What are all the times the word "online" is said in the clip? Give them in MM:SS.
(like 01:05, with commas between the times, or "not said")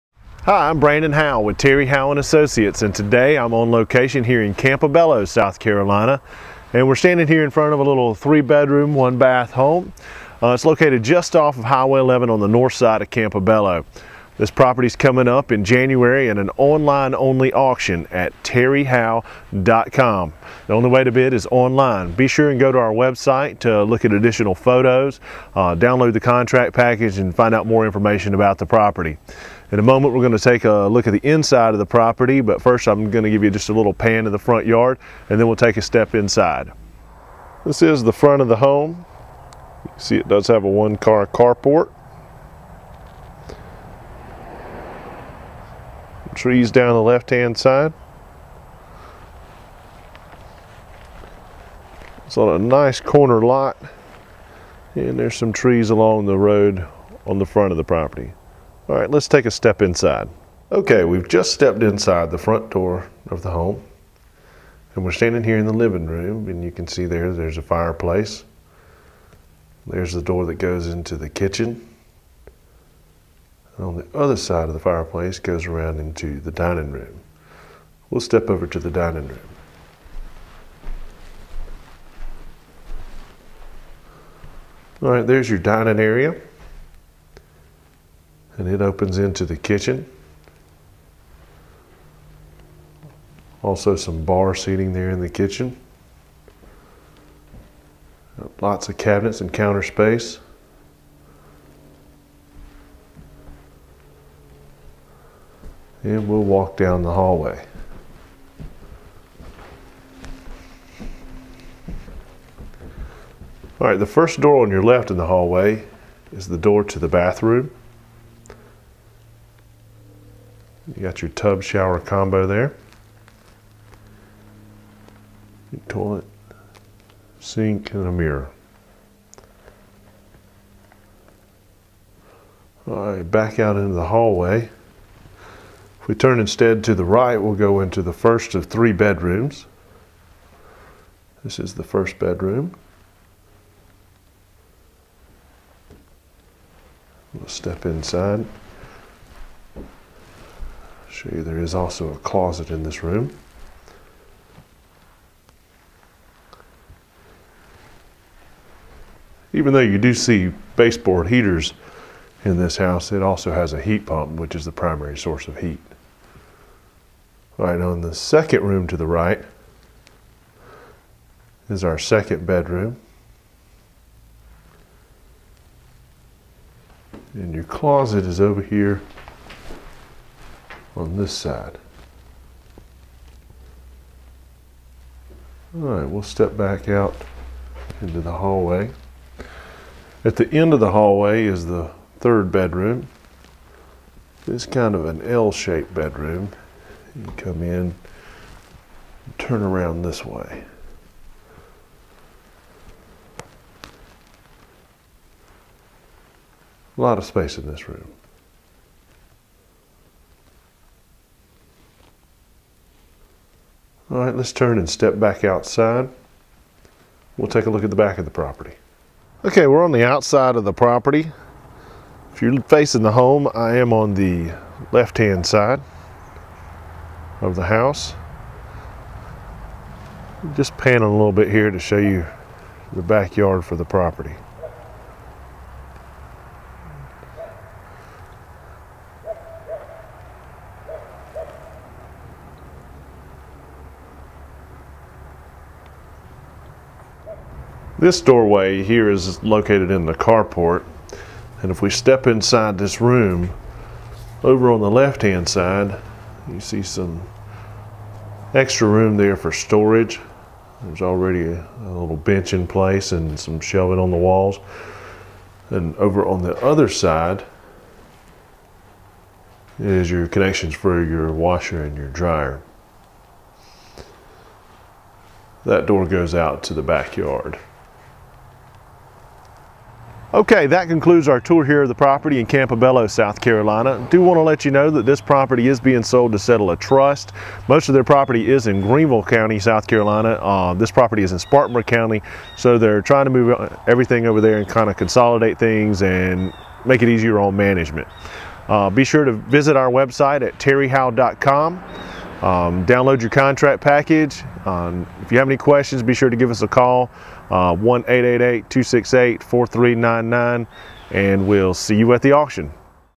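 00:16, 00:21.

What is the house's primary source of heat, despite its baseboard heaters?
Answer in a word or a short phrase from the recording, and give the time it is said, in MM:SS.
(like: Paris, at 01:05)
Heat pump, at 02:43.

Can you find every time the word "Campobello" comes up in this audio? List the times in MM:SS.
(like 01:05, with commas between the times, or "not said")
00:04, 00:13, 04:42.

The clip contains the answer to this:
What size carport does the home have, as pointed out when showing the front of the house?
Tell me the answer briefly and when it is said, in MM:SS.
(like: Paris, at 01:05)
One-car, at 00:40.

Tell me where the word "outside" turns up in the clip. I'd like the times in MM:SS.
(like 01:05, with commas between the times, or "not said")
03:35, 03:40.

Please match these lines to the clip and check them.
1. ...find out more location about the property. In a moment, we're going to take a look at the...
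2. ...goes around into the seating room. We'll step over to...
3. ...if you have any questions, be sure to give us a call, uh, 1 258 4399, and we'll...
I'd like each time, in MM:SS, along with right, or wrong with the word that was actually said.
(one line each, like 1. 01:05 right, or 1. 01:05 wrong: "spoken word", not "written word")
1. 00:27 wrong: "information", not "location"
2. 01:15 wrong: "dining", not "seating"
3. 05:05 wrong: "268", not "258".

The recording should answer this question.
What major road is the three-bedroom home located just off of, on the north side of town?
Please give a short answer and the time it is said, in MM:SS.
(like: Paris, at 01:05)
Highway 11, at 00:11.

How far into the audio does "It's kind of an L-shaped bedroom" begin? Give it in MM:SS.
03:14.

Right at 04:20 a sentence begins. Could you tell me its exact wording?
There's already a, little bench in place and some shelving on the walls.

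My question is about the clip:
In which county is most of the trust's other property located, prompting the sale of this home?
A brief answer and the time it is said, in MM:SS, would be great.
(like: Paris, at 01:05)
Greenville County, at 04:48.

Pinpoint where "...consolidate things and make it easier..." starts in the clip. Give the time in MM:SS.
04:54.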